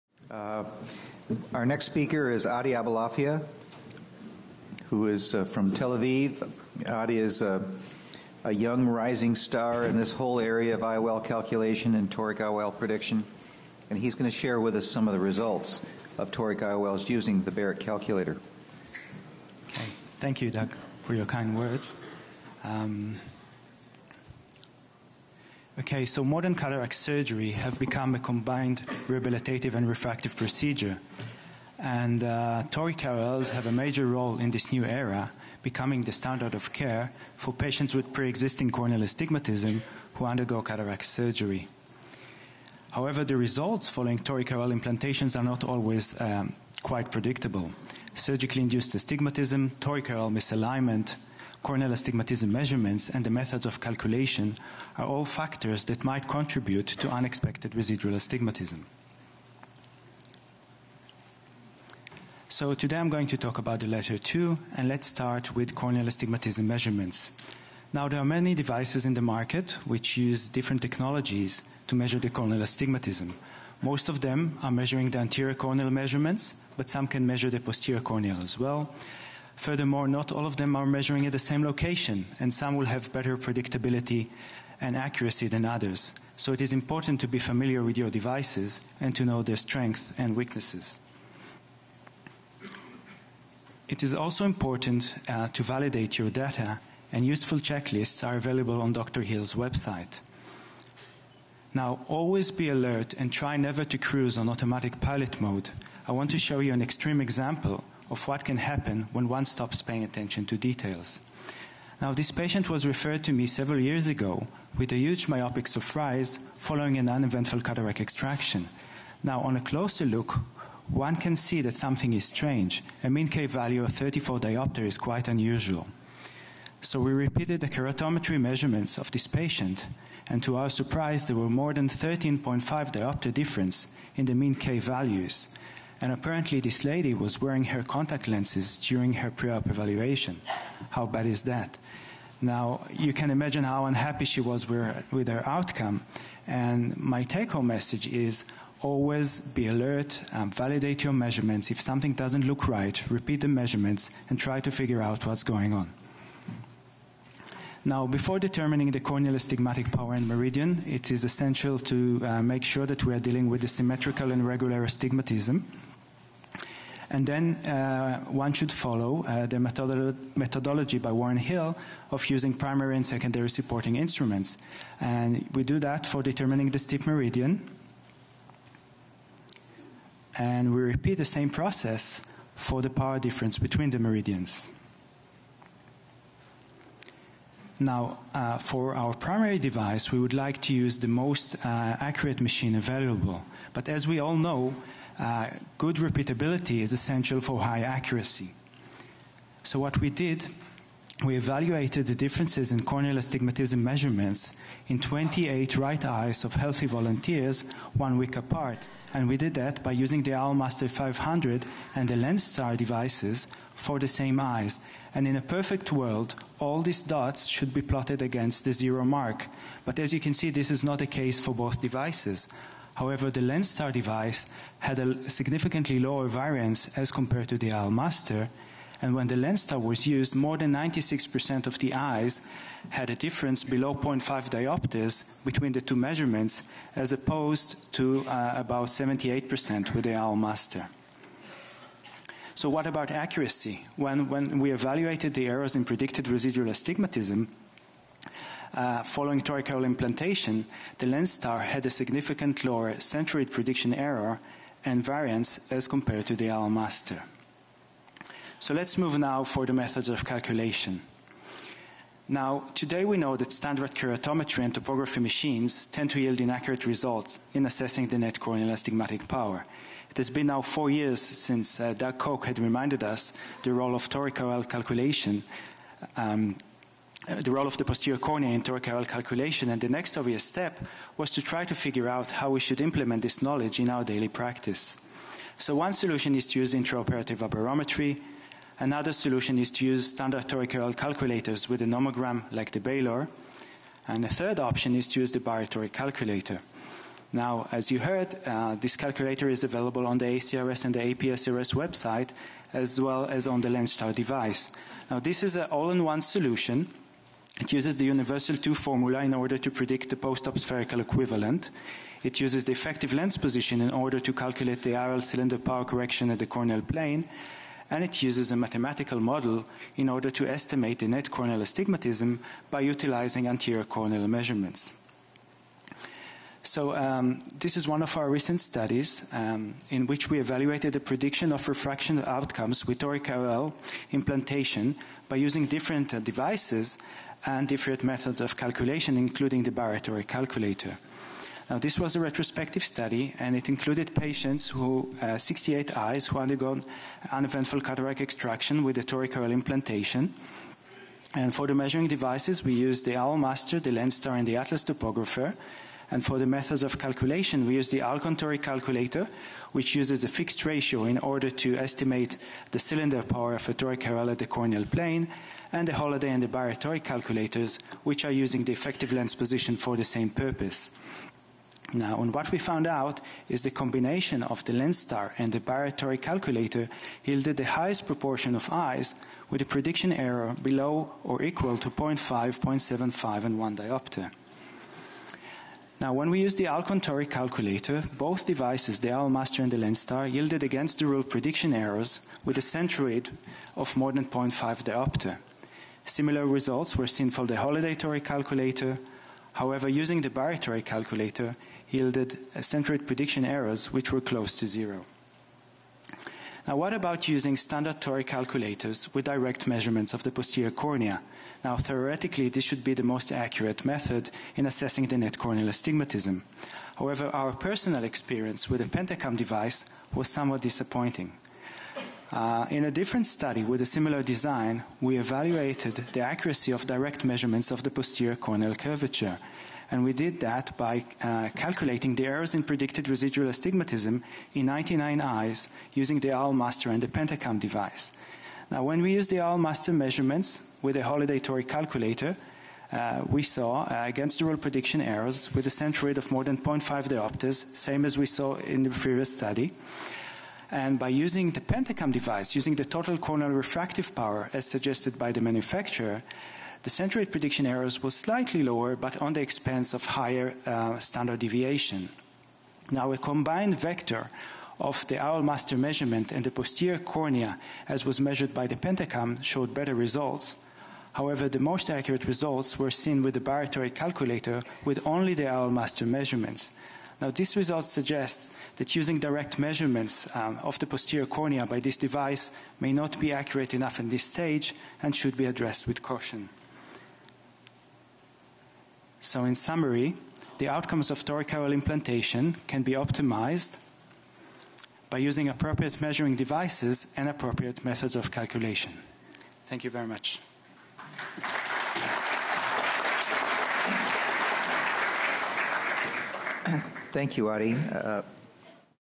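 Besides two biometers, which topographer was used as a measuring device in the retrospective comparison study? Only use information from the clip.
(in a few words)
Atlas.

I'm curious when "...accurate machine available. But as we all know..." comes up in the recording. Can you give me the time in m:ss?
3:11.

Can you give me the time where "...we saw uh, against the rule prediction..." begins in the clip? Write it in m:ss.
7:23.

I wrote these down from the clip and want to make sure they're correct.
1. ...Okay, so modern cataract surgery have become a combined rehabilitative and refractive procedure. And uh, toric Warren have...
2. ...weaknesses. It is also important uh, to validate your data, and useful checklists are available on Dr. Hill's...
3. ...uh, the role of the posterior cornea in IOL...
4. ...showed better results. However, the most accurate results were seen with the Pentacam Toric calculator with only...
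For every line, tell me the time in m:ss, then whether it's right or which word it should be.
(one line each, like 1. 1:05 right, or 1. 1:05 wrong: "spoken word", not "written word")
1. 0:25 wrong: "IOLs", not "Warren"
2. 1:30 right
3. 4:37 right
4. 7:49 wrong: "Barrett", not "Pentacam".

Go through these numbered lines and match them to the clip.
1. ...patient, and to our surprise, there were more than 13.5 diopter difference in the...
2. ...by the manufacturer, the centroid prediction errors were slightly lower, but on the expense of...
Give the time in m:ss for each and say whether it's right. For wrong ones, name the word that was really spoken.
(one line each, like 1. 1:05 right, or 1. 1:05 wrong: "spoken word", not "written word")
1. 2:09 right
2. 7:35 right.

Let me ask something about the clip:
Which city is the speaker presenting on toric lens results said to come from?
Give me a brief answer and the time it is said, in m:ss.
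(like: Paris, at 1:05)
Tel Aviv, at 0:05.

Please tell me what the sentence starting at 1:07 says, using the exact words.
Now there are many devices in the market which use different technologies to measure the corneal astigmatism.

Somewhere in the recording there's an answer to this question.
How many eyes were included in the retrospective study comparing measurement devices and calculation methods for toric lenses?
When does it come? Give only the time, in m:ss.
5:45.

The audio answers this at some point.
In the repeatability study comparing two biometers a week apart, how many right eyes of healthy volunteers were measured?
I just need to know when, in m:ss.
3:24.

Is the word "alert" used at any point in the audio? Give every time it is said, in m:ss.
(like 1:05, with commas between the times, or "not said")
1:42, 2:29.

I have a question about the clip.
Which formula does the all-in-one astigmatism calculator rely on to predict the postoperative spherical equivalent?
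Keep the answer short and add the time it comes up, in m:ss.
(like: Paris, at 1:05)
Universal 2, at 5:08.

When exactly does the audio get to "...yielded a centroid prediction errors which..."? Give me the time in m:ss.
6:41.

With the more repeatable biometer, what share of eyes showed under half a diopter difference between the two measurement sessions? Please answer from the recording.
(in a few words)
more than 96%.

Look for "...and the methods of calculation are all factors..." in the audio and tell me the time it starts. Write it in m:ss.
0:53.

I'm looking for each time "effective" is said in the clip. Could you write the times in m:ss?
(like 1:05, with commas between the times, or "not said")
5:12, 6:08.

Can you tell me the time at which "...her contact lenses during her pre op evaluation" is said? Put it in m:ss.
2:17.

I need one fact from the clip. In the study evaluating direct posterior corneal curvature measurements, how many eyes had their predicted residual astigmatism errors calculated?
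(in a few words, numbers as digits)
99.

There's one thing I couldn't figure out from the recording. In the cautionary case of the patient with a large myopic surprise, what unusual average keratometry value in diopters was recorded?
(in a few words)
34.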